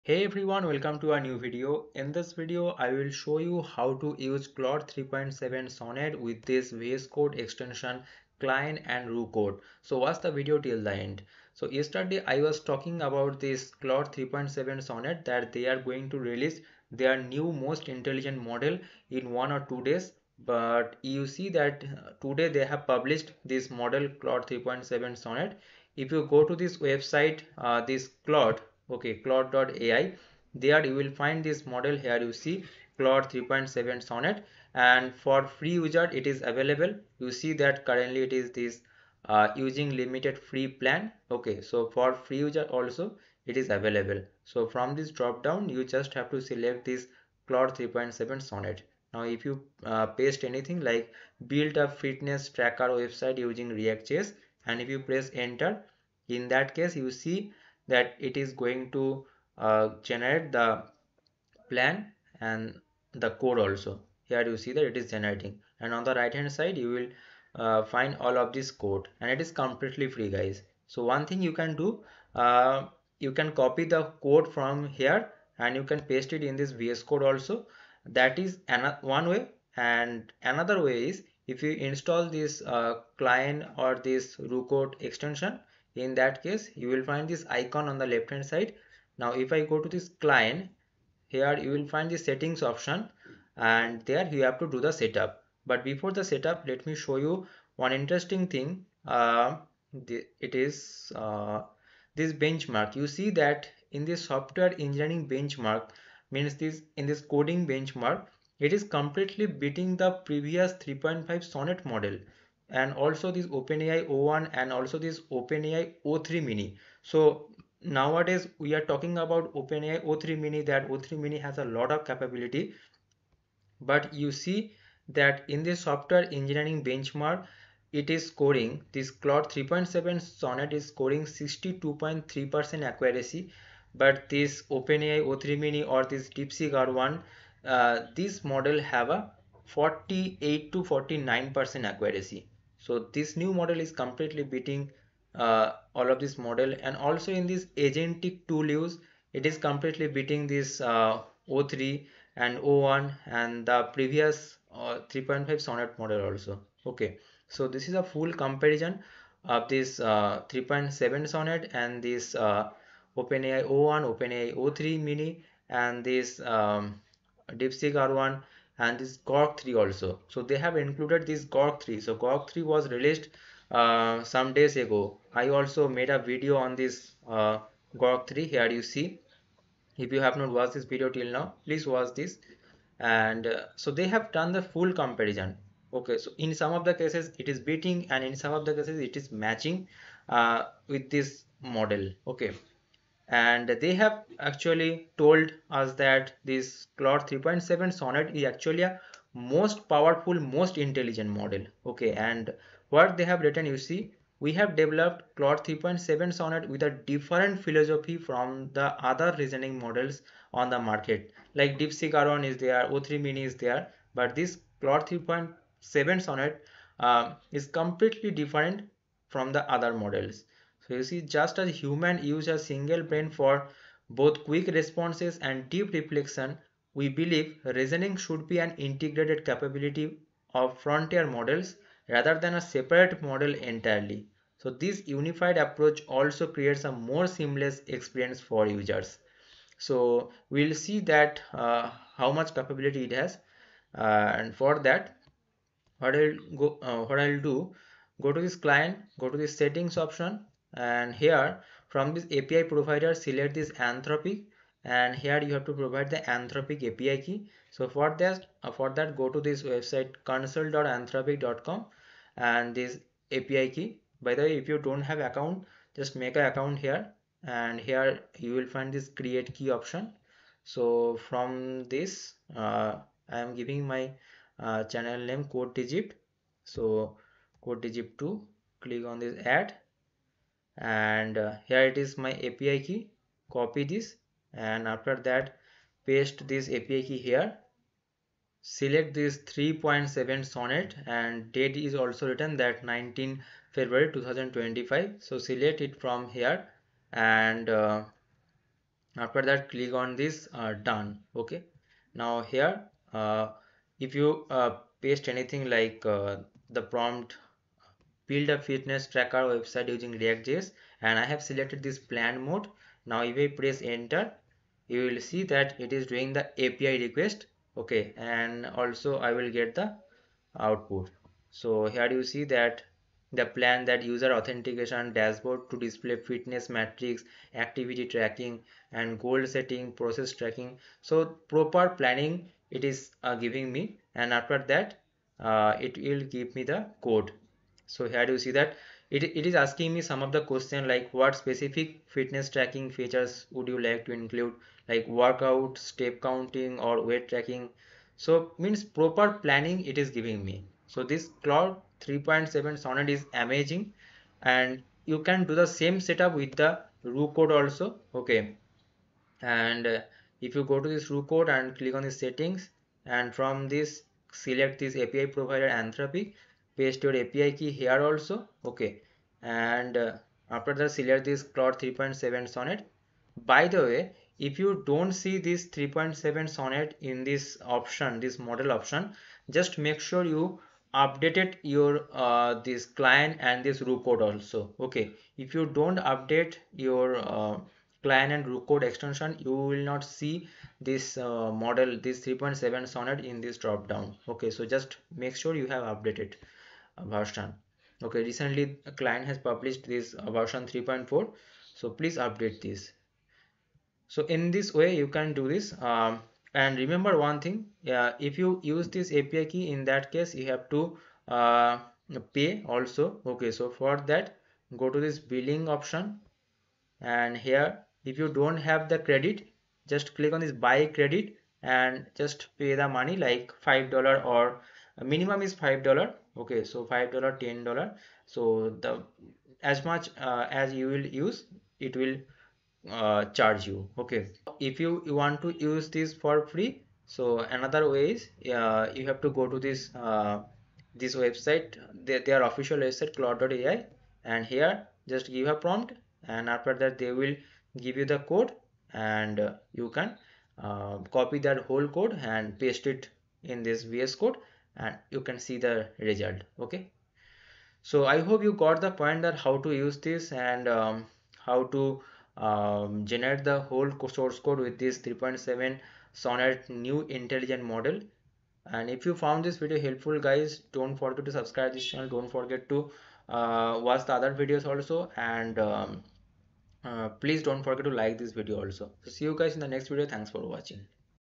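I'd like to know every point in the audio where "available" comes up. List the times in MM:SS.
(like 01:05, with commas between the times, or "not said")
00:36, 00:43.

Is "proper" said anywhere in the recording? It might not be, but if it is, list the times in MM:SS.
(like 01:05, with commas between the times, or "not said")
05:31, 05:48.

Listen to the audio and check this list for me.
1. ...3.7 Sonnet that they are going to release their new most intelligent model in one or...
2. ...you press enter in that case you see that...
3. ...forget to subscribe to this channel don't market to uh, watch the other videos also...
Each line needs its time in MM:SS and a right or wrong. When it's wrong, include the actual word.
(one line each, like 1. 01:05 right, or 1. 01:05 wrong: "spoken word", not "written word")
1. 00:14 right
2. 00:54 right
3. 07:50 wrong: "forget", not "market".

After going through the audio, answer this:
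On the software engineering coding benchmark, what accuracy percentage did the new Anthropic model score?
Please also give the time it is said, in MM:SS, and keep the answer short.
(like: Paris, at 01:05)
62.3%, at 02:11.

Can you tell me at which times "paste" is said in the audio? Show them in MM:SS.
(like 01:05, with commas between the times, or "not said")
00:50, 01:16, 04:46, 05:05, 06:06, 07:32.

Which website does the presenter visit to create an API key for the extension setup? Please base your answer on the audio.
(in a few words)
console.anthropic.com.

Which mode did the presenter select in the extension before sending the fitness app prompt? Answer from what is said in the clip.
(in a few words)
Plan mode.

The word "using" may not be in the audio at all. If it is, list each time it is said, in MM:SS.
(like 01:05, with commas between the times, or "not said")
00:39, 00:53, 05:09.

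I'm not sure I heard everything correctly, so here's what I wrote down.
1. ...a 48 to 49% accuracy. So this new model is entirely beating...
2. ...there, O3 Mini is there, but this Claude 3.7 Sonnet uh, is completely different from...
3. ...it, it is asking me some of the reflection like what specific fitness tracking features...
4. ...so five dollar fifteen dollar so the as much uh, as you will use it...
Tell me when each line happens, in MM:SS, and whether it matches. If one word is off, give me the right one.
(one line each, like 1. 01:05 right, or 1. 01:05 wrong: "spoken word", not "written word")
1. 02:19 wrong: "completely", not "entirely"
2. 03:32 right
3. 05:39 wrong: "question", not "reflection"
4. 07:06 wrong: "ten", not "fifteen".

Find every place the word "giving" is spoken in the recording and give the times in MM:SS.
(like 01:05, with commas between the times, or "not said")
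04:33, 05:33, 05:50.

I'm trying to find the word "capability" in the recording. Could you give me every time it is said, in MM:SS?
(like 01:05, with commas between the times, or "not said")
02:02, 03:49, 04:02.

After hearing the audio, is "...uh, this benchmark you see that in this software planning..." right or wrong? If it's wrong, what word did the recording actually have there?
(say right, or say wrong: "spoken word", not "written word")
wrong: "engineering", not "planning".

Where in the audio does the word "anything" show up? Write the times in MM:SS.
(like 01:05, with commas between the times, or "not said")
00:50, 05:05.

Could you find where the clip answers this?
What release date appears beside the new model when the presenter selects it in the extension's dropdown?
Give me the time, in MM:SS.
04:52.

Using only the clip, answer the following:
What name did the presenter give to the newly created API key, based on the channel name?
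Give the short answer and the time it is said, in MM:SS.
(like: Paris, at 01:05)
code digit 2, at 04:37.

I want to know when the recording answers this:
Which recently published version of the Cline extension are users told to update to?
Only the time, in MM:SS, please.
06:40.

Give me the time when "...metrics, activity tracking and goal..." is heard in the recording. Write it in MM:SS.
05:26.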